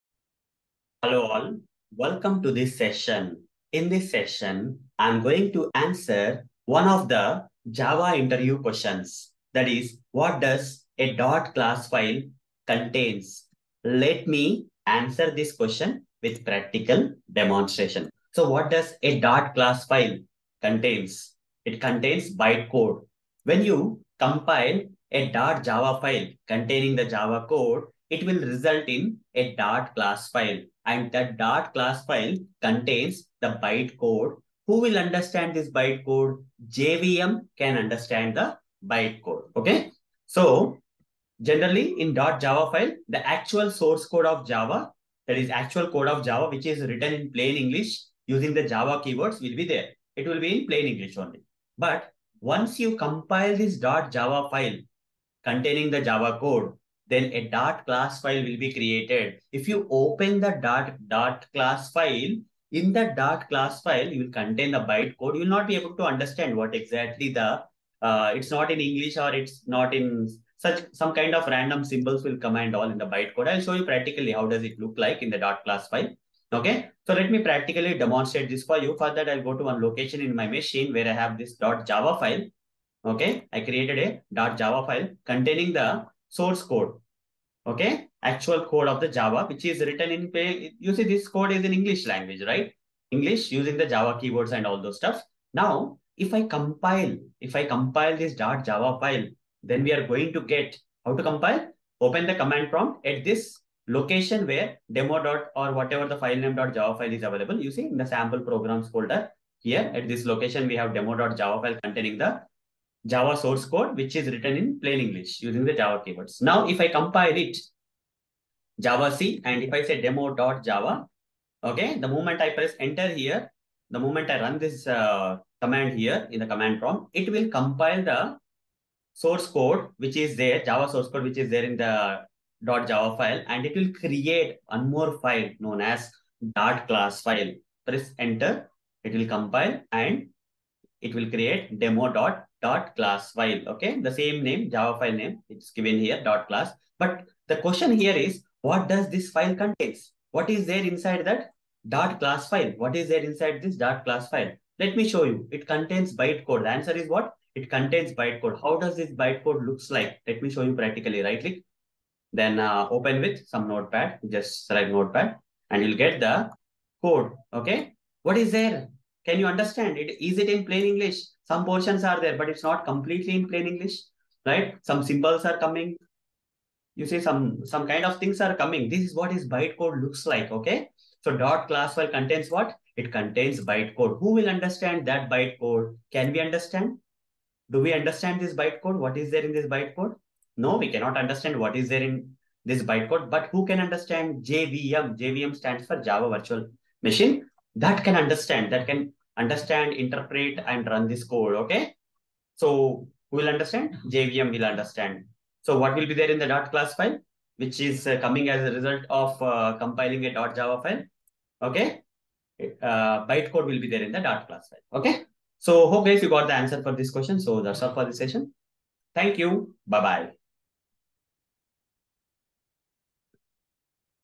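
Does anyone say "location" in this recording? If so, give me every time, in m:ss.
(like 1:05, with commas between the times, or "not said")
1:19, 1:43, 1:50.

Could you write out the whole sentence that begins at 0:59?
If you open the dot, dot class file, in the dot class file, you will contain the bytecode.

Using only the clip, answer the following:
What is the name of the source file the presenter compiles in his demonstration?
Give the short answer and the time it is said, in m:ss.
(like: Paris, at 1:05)
demo.java, at 2:00.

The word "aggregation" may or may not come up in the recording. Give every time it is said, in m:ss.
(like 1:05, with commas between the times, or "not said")
not said.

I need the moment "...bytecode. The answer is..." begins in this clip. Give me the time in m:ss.
2:36.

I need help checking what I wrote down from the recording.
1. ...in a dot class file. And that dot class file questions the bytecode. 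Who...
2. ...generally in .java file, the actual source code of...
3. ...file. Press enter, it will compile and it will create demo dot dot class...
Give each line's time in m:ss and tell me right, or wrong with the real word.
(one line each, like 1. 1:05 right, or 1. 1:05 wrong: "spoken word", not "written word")
1. 0:28 wrong: "contains", not "questions"
2. 0:41 right
3. 2:17 right.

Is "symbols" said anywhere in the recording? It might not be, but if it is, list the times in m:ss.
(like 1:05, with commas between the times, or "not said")
1:11, 2:55.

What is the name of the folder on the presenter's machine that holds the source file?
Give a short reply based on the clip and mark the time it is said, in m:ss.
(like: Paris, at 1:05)
sample programs, at 1:48.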